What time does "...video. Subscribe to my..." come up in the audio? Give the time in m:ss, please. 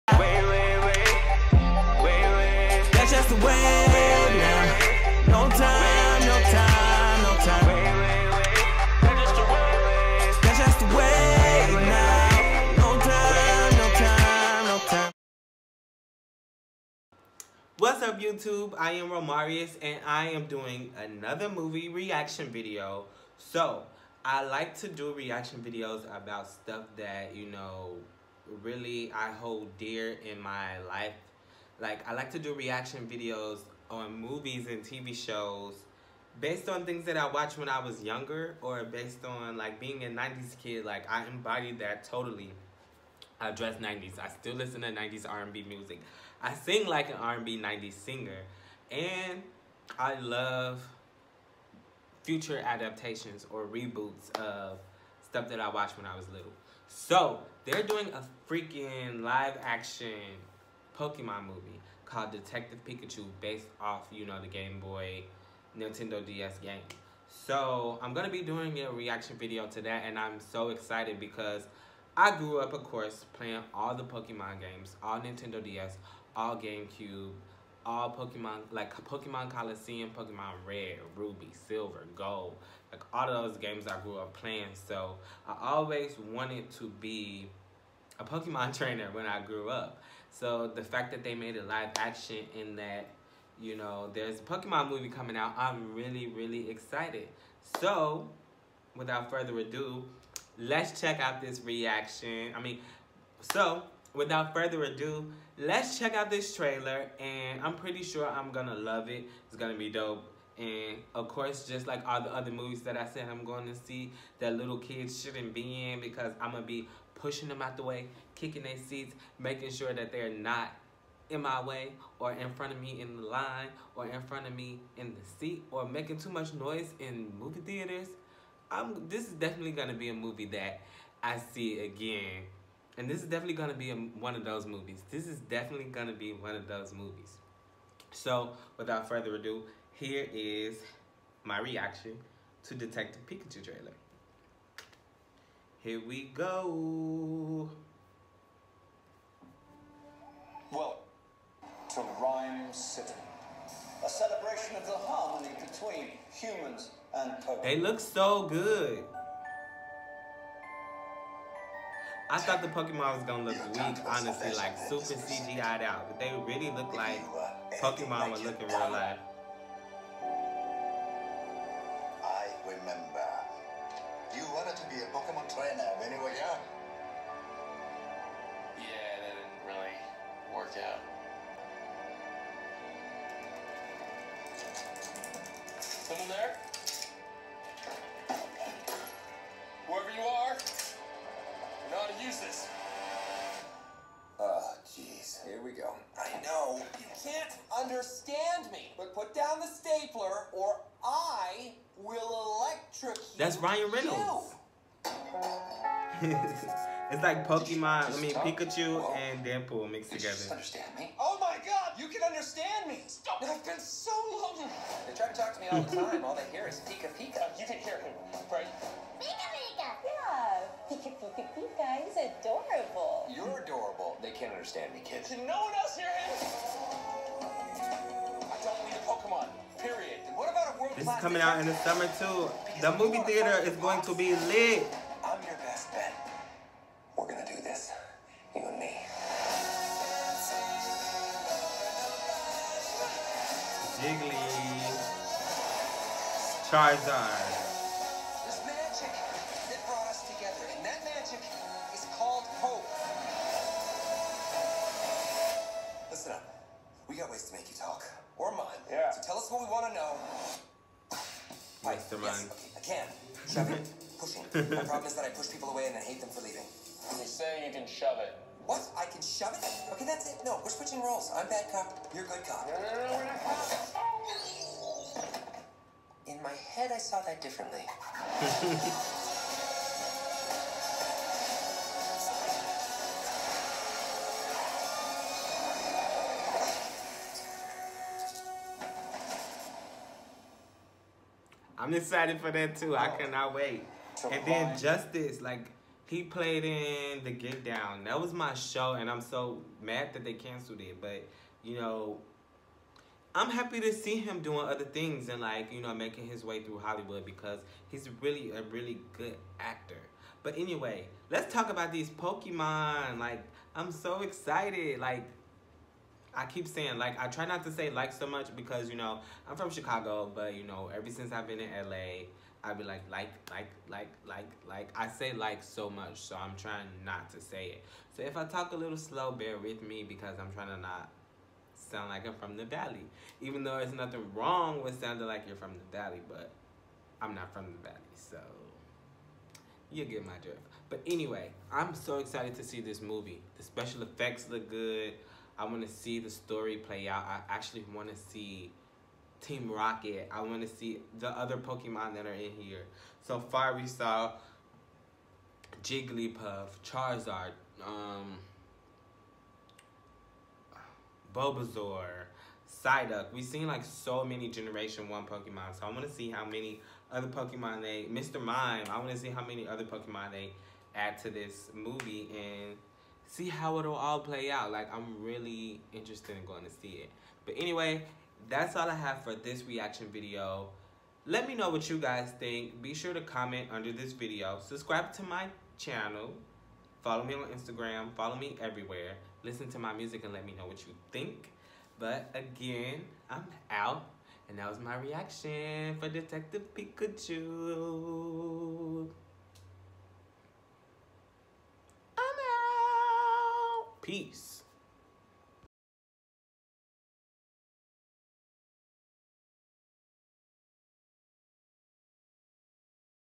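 6:24.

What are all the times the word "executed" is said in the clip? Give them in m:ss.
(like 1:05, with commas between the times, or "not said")
not said.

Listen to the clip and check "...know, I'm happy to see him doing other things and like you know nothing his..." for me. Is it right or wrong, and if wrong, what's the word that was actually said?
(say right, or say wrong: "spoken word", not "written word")
wrong: "making", not "nothing".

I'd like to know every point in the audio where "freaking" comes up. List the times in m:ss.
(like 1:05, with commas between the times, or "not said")
0:58.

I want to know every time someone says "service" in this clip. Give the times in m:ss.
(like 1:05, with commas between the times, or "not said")
not said.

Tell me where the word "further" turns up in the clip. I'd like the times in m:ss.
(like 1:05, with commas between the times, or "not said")
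1:39, 1:44, 2:19.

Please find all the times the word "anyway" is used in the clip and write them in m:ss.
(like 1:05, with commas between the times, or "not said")
5:10, 5:41, 6:17.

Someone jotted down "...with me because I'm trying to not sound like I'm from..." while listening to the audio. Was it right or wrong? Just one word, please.
right.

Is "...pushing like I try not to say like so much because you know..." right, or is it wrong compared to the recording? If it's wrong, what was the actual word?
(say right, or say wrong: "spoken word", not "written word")
wrong: "saying", not "pushing".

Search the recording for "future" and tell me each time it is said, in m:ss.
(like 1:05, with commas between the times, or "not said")
0:52.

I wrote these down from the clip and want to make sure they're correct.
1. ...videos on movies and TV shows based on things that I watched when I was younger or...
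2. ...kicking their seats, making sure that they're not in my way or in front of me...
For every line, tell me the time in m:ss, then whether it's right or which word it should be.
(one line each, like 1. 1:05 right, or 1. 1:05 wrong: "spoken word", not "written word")
1. 0:33 right
2. 1:58 right.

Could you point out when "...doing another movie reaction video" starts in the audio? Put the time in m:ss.
0:20.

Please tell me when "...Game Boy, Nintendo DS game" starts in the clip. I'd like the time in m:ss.
1:04.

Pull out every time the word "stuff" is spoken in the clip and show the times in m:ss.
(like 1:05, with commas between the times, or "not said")
0:26, 0:55.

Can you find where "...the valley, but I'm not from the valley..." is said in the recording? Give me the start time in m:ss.
5:35.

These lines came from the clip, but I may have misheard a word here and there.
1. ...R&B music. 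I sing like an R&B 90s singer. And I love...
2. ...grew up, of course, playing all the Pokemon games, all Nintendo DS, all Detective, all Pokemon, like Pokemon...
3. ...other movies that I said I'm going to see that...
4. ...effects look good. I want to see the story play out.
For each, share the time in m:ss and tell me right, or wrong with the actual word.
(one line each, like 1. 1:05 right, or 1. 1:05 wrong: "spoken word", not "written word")
1. 0:45 right
2. 1:12 wrong: "GameCube", not "Detective"
3. 1:52 right
4. 5:44 right.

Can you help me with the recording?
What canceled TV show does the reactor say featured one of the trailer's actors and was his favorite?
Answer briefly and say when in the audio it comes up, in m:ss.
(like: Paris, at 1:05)
The Get Down, at 4:57.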